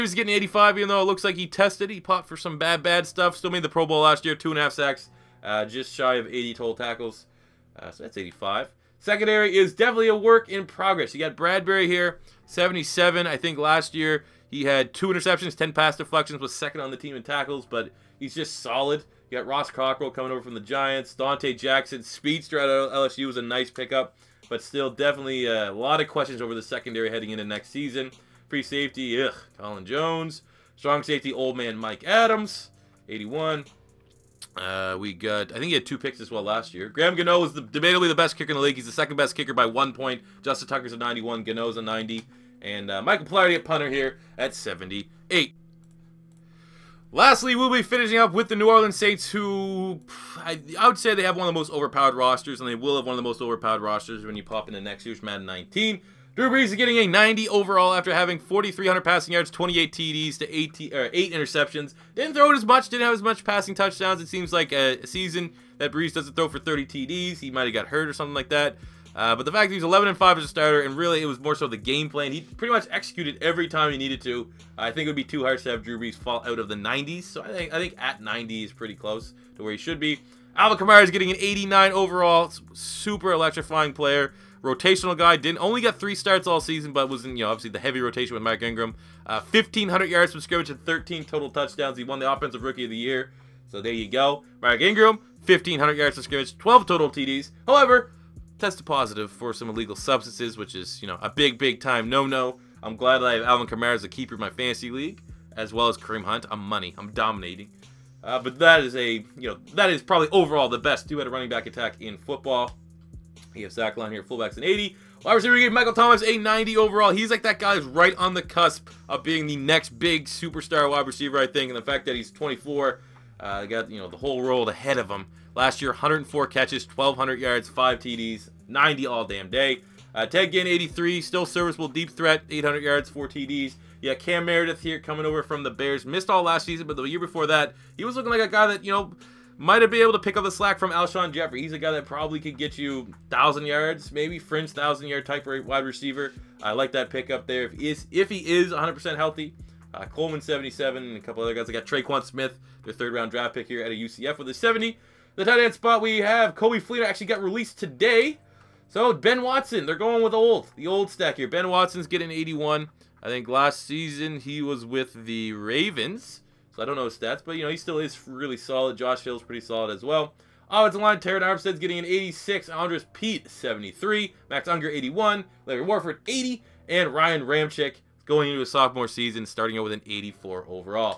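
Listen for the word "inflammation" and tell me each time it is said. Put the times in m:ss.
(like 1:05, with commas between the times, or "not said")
not said.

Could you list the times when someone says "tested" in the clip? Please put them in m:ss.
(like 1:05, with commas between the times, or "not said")
0:01, 1:38.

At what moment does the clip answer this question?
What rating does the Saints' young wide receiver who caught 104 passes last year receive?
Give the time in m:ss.
1:55.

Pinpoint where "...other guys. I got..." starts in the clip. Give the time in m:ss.
2:31.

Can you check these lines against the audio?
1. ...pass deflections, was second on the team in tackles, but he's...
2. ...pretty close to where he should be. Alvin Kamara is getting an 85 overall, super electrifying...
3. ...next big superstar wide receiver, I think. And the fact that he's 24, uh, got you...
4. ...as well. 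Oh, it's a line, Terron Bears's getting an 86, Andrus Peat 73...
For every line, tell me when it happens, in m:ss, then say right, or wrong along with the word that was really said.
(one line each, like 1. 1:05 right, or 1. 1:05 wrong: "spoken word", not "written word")
1. 0:15 right
2. 1:18 wrong: "89", not "85"
3. 1:59 right
4. 2:49 wrong: "Armstead", not "Bears".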